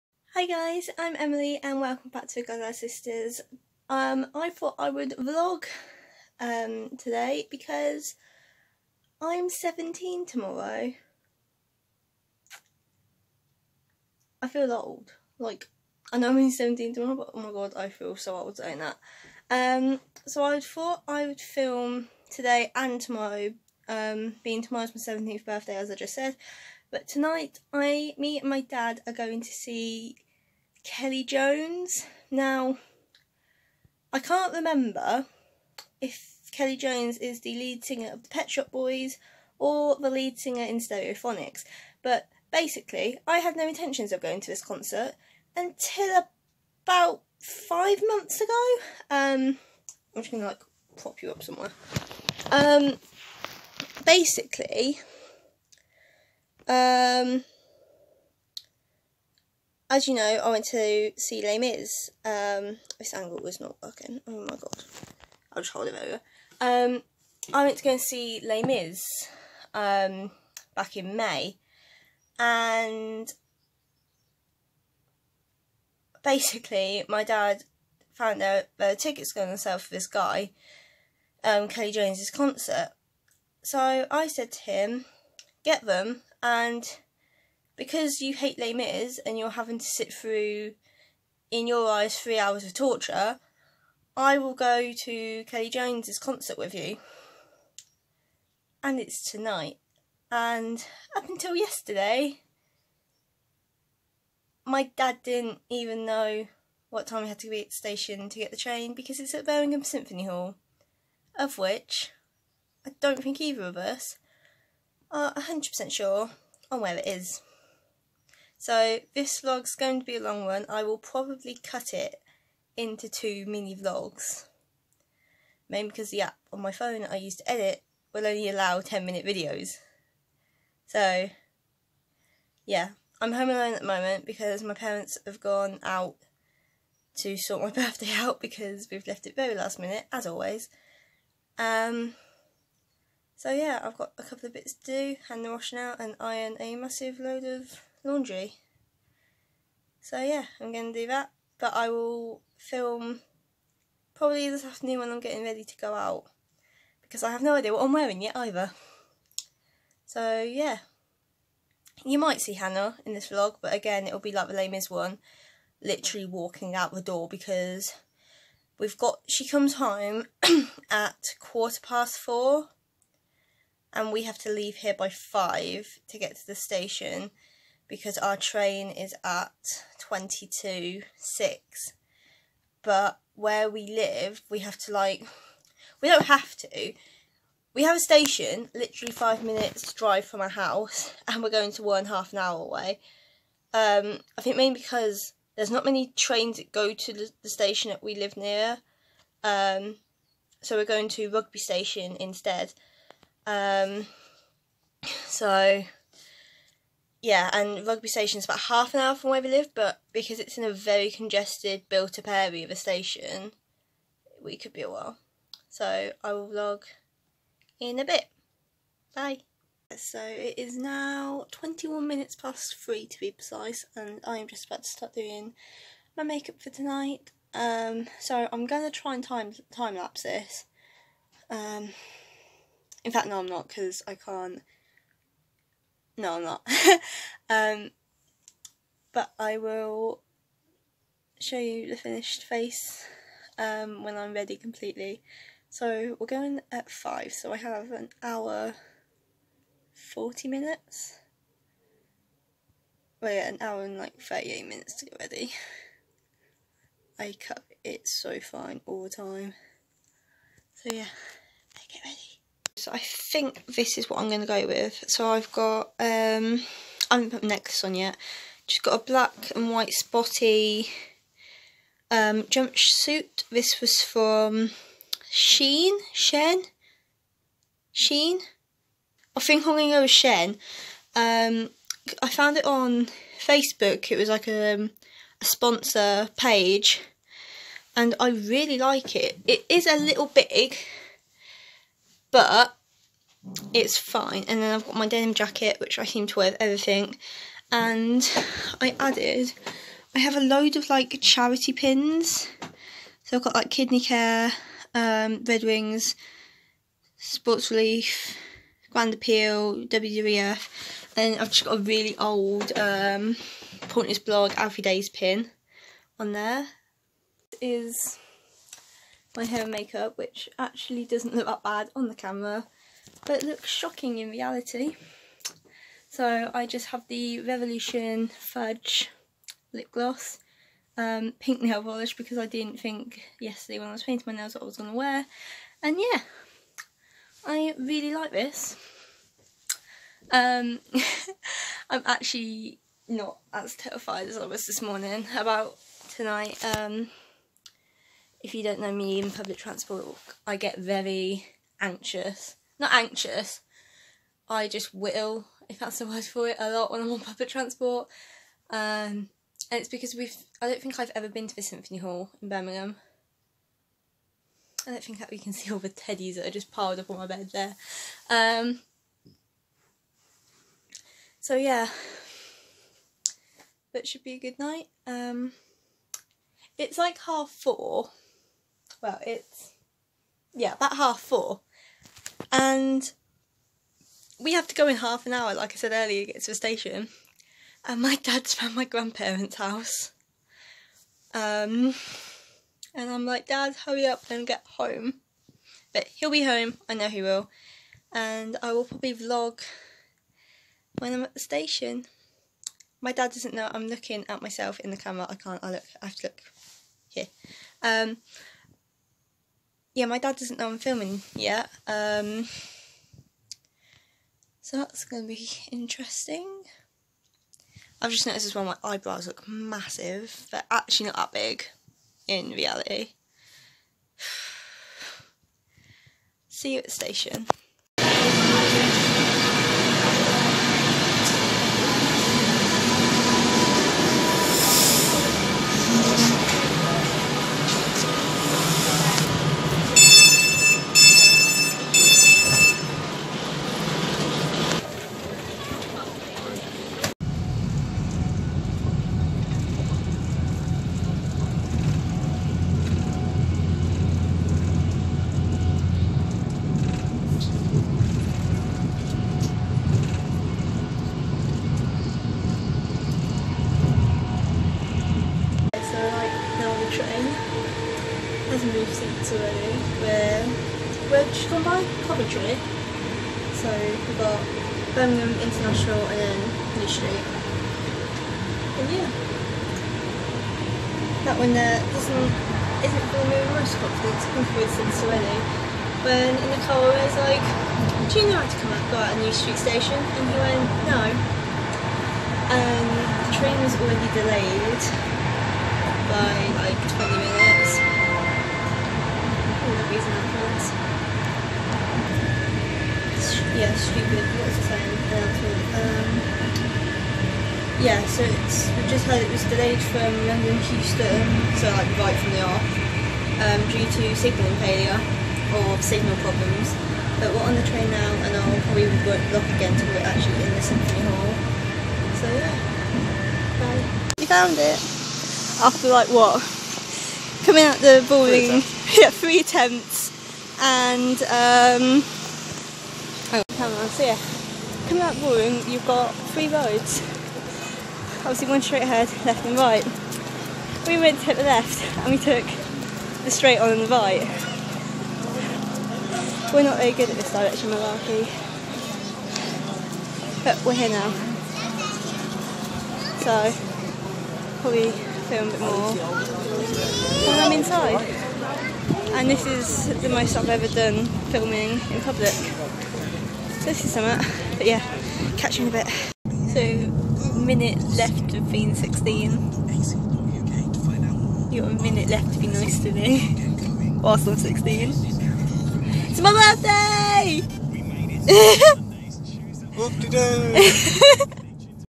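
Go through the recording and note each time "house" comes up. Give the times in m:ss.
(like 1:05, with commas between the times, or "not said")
3:10, 6:29.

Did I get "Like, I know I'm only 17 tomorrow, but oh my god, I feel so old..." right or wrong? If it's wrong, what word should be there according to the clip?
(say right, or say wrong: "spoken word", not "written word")
right.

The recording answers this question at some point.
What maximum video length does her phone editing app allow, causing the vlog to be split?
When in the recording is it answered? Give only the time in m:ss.
2:08.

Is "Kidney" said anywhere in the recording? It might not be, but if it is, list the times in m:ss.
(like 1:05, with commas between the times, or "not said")
5:03.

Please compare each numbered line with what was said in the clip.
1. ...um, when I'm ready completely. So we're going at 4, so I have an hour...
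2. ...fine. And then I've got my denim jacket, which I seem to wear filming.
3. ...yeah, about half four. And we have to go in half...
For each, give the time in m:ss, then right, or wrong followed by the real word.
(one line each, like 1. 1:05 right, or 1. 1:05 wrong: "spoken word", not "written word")
1. 4:03 wrong: "5", not "4"
2. 4:53 wrong: "everything", not "filming"
3. 6:20 right.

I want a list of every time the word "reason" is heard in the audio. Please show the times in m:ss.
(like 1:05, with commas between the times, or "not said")
8:19.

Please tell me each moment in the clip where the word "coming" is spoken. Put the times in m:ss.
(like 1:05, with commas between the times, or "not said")
8:47, 8:54.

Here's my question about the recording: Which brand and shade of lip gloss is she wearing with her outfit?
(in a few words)
Revolution Fudge.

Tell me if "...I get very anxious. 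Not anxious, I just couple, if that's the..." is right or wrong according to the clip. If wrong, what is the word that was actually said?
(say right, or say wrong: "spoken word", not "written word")
wrong: "whittle", not "couple".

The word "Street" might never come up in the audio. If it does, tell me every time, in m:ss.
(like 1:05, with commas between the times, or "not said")
7:56, 8:09.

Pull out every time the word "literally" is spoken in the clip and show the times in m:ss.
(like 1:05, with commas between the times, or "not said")
2:45, 3:08.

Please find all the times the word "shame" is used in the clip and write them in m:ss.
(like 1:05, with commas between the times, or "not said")
not said.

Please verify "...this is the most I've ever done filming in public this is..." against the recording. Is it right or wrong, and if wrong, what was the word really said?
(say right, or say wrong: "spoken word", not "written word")
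right.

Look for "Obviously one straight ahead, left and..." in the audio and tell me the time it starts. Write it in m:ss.
8:58.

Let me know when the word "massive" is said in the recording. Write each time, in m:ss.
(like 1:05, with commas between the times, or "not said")
2:26, 6:59.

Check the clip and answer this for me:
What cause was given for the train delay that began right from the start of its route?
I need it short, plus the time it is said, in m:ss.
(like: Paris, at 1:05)
Signal failure, at 8:34.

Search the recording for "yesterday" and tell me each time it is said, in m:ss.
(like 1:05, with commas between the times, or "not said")
1:41, 5:33.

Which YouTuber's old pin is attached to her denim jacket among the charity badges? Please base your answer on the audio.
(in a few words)
Alfie Deyes.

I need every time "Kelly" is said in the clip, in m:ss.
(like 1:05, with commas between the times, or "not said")
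0:30, 0:36, 1:21, 1:35.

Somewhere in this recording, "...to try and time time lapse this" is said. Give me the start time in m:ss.
3:48.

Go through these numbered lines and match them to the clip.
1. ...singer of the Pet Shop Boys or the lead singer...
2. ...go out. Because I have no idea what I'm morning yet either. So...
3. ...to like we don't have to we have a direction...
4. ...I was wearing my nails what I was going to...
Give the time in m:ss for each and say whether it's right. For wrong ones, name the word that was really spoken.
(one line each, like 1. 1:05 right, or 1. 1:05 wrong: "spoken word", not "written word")
1. 0:37 right
2. 2:35 wrong: "wearing", not "morning"
3. 3:04 wrong: "station", not "direction"
4. 5:33 wrong: "painting", not "wearing".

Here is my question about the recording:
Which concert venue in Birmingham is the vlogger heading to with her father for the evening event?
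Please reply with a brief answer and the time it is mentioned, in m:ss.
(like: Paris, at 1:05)
Birmingham Symphony Hall, at 1:49.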